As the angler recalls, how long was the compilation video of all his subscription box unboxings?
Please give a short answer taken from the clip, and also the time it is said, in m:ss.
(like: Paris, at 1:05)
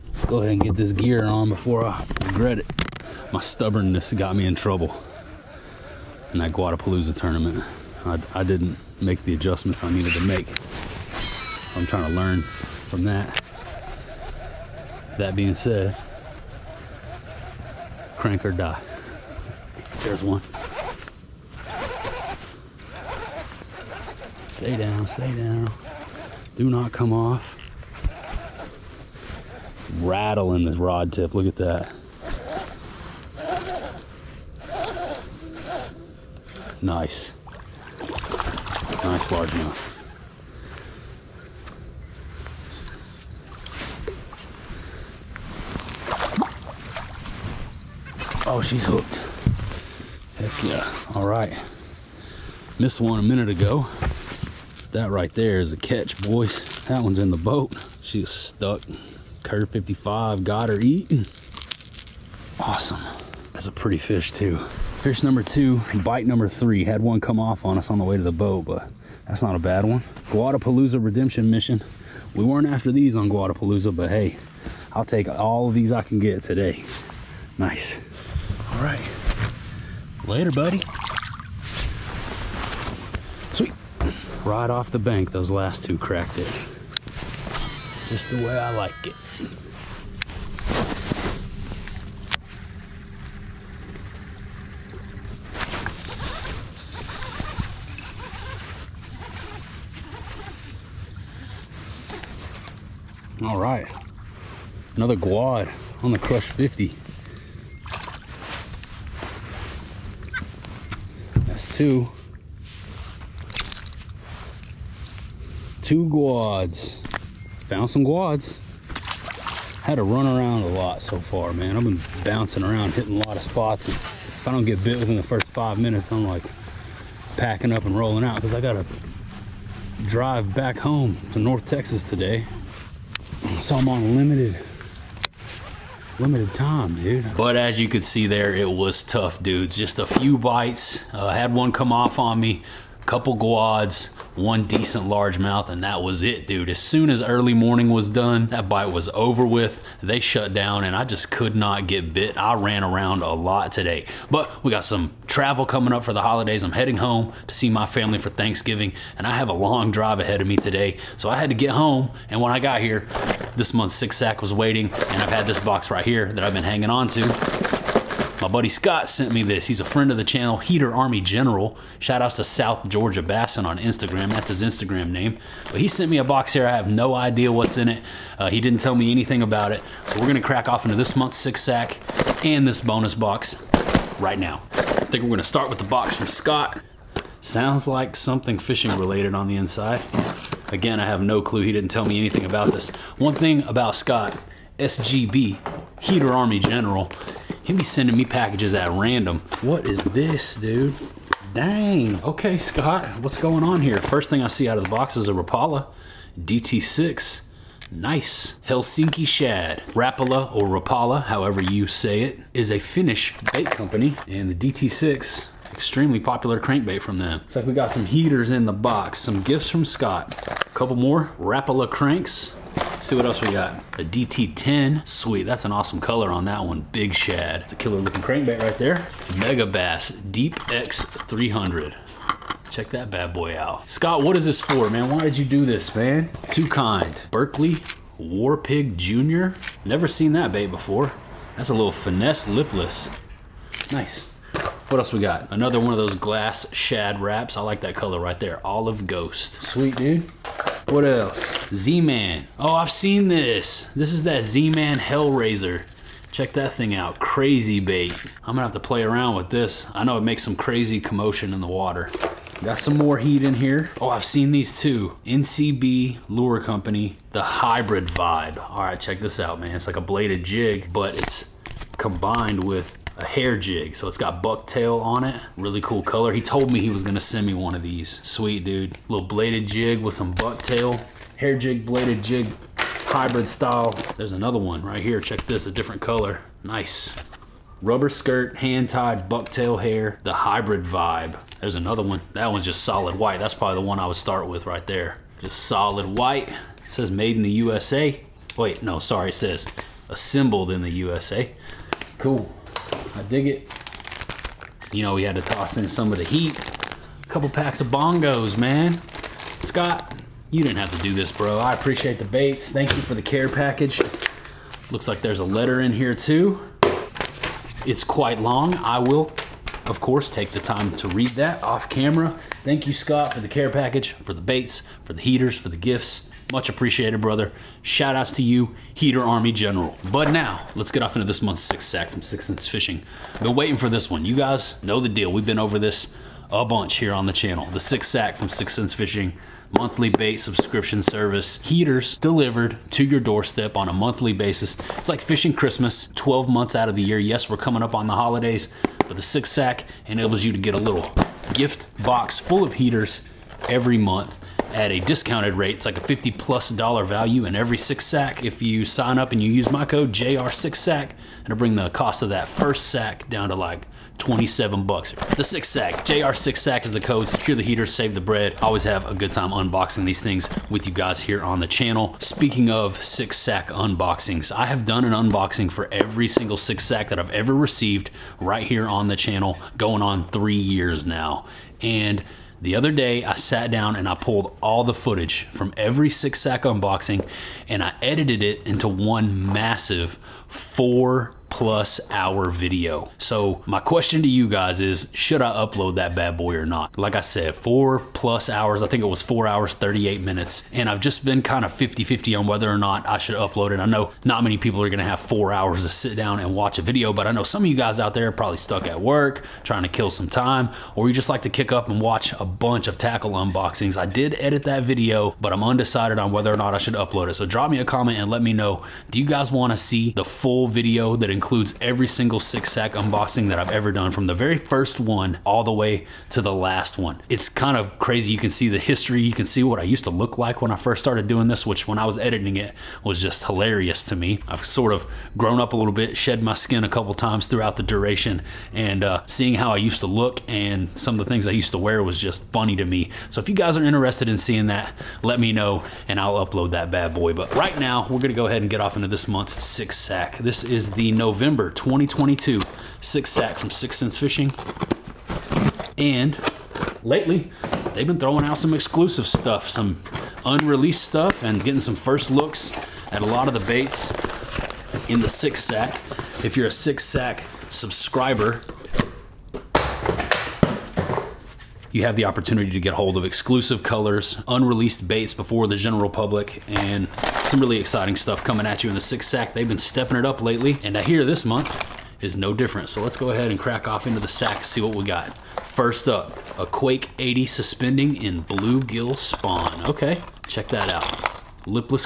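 4 hours, 38 minutes, at 6:39.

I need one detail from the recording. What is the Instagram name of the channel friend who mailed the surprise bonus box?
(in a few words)
South Georgia Bassin.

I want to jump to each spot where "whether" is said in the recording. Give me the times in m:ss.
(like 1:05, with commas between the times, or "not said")
6:42, 6:56.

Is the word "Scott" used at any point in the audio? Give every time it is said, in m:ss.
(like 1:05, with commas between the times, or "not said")
2:48, 3:06, 3:13, 3:22, 3:39, 3:53, 5:09, 5:22.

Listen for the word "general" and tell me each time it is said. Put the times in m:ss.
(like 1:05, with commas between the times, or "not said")
2:51, 3:16, 5:29, 7:55.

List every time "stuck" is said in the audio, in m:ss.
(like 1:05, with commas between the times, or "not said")
0:58, 6:48.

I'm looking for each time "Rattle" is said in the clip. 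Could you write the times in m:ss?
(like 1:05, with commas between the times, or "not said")
0:30.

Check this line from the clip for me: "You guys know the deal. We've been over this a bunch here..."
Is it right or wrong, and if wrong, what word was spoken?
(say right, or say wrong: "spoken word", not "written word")
right.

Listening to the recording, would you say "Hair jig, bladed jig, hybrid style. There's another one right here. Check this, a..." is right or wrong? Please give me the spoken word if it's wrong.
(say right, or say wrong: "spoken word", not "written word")
right.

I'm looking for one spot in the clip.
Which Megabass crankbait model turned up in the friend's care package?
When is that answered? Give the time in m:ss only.
3:50.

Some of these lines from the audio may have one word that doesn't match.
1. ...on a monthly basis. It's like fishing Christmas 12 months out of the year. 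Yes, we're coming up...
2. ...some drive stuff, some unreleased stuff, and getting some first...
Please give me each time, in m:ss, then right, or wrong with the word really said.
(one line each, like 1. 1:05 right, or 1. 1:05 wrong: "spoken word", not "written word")
1. 5:43 right
2. 7:38 wrong: "exclusive", not "drive".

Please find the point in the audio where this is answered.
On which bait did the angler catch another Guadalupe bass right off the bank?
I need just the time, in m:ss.
1:46.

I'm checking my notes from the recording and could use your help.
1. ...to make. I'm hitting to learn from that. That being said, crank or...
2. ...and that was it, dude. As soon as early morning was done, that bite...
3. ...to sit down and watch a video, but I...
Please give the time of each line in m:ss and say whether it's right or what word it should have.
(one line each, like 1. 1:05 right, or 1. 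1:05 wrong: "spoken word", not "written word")
1. 0:10 wrong: "trying", not "hitting"
2. 2:25 right
3. 6:45 right.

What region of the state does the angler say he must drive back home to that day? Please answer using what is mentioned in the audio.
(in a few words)
North Texas.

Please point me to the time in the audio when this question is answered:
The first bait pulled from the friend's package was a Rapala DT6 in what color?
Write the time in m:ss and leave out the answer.
3:28.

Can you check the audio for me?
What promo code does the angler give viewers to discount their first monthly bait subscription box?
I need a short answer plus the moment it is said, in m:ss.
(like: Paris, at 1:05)
JR6SACK, at 6:00.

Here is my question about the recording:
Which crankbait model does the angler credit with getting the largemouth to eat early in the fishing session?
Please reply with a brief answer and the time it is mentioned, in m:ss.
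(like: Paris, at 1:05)
Curve 55, at 0:59.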